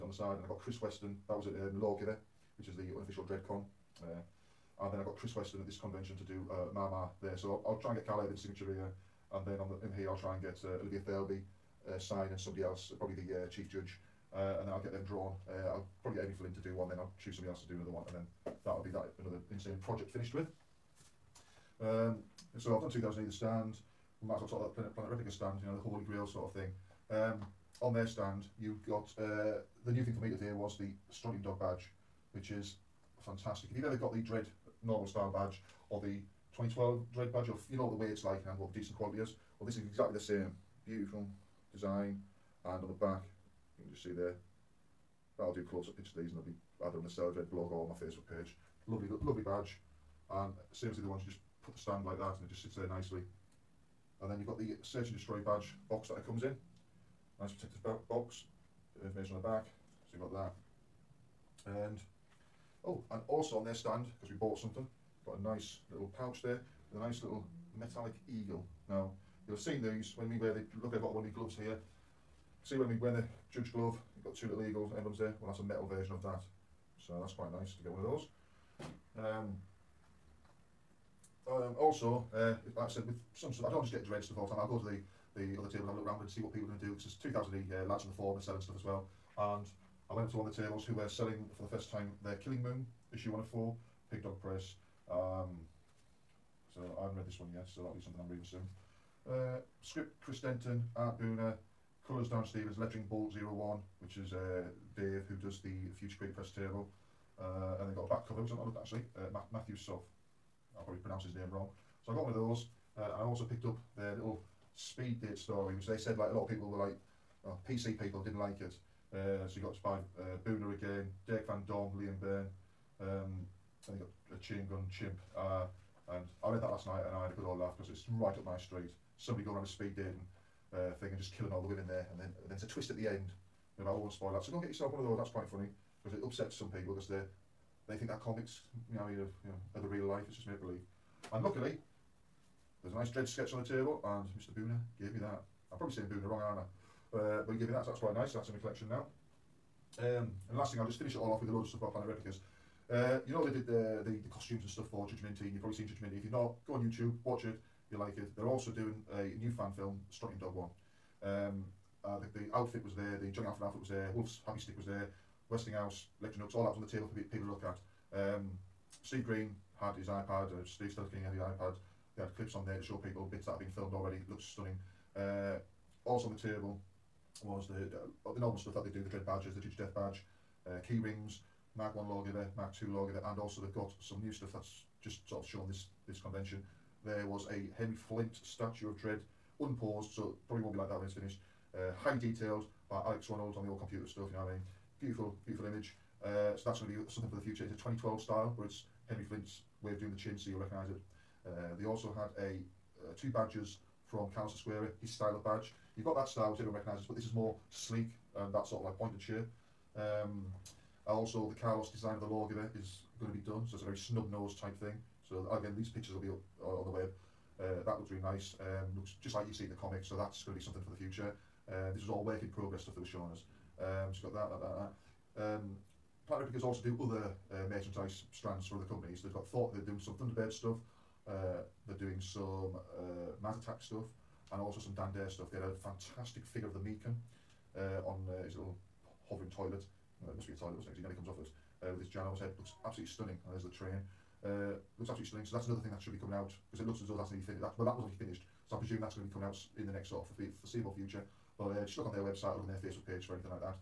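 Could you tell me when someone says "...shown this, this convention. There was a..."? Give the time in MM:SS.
03:05.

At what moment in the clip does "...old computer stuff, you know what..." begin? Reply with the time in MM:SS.
03:13.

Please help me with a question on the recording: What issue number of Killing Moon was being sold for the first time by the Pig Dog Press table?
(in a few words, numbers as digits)
104.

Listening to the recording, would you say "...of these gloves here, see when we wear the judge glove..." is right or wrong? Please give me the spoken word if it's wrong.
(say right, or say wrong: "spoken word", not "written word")
right.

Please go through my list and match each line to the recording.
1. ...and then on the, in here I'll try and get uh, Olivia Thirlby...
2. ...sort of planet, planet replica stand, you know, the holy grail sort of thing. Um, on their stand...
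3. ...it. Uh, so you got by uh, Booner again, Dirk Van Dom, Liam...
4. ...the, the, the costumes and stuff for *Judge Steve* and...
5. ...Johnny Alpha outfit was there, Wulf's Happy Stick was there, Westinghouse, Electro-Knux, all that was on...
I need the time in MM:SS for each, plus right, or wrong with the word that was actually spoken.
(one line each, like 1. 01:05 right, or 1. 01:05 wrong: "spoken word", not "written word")
1. 00:09 right
2. 00:24 right
3. 01:58 right
4. 02:33 wrong: "Minty", not "Steve"
5. 02:43 right.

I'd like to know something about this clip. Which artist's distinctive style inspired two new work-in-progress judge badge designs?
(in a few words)
Carlos Ezquerra.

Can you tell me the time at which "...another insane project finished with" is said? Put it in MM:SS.
00:19.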